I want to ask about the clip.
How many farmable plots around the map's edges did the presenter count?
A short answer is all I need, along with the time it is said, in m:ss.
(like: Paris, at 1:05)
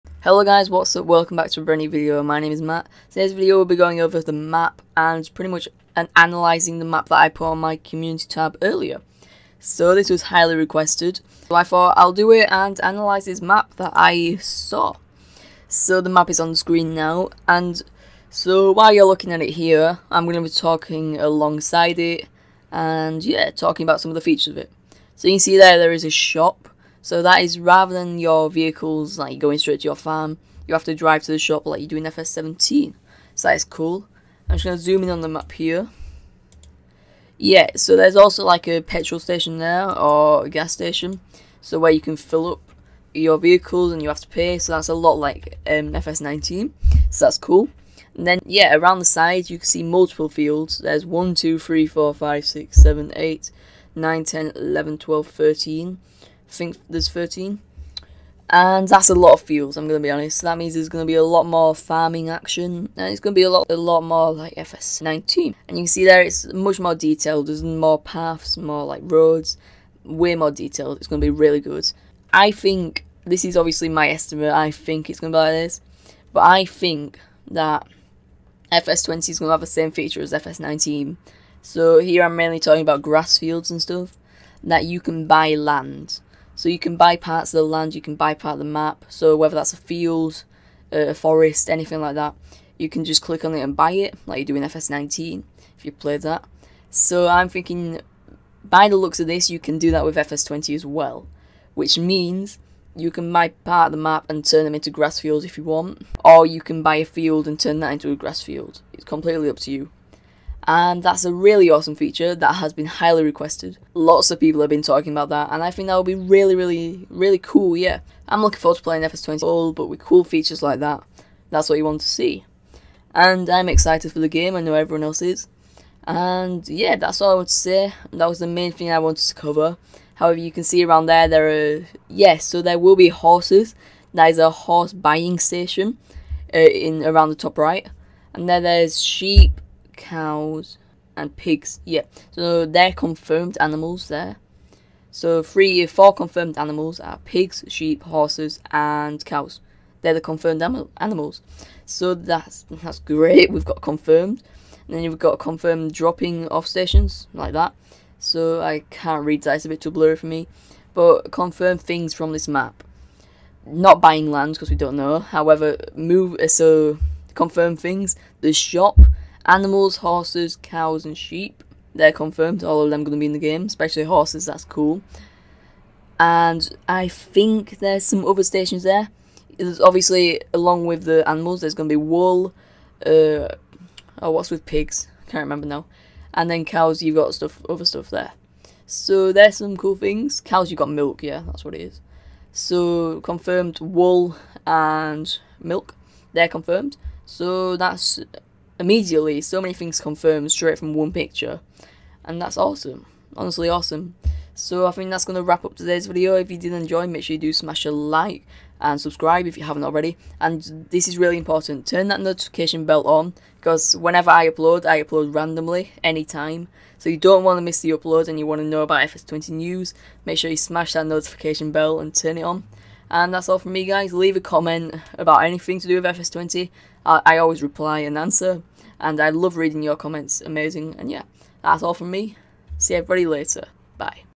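13, at 0:56.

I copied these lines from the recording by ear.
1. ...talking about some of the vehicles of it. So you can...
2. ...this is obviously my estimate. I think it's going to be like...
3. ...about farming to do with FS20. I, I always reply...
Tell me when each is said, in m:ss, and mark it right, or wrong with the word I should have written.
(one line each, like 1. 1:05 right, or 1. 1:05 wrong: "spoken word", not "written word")
1. 0:23 wrong: "features", not "vehicles"
2. 1:13 right
3. 3:45 wrong: "anything", not "farming".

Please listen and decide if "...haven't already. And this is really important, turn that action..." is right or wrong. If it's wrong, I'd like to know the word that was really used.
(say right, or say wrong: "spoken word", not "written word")
wrong: "notification", not "action".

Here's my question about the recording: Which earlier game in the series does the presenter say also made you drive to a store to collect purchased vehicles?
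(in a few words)
FS17.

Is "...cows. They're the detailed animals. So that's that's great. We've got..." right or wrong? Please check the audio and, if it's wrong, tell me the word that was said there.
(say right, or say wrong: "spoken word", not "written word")
wrong: "confirmed", not "detailed".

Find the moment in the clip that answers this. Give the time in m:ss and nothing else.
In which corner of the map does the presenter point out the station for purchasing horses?
2:17.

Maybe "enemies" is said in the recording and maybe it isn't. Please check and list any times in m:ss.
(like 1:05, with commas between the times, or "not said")
not said.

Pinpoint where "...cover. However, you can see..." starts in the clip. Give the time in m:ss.
2:09.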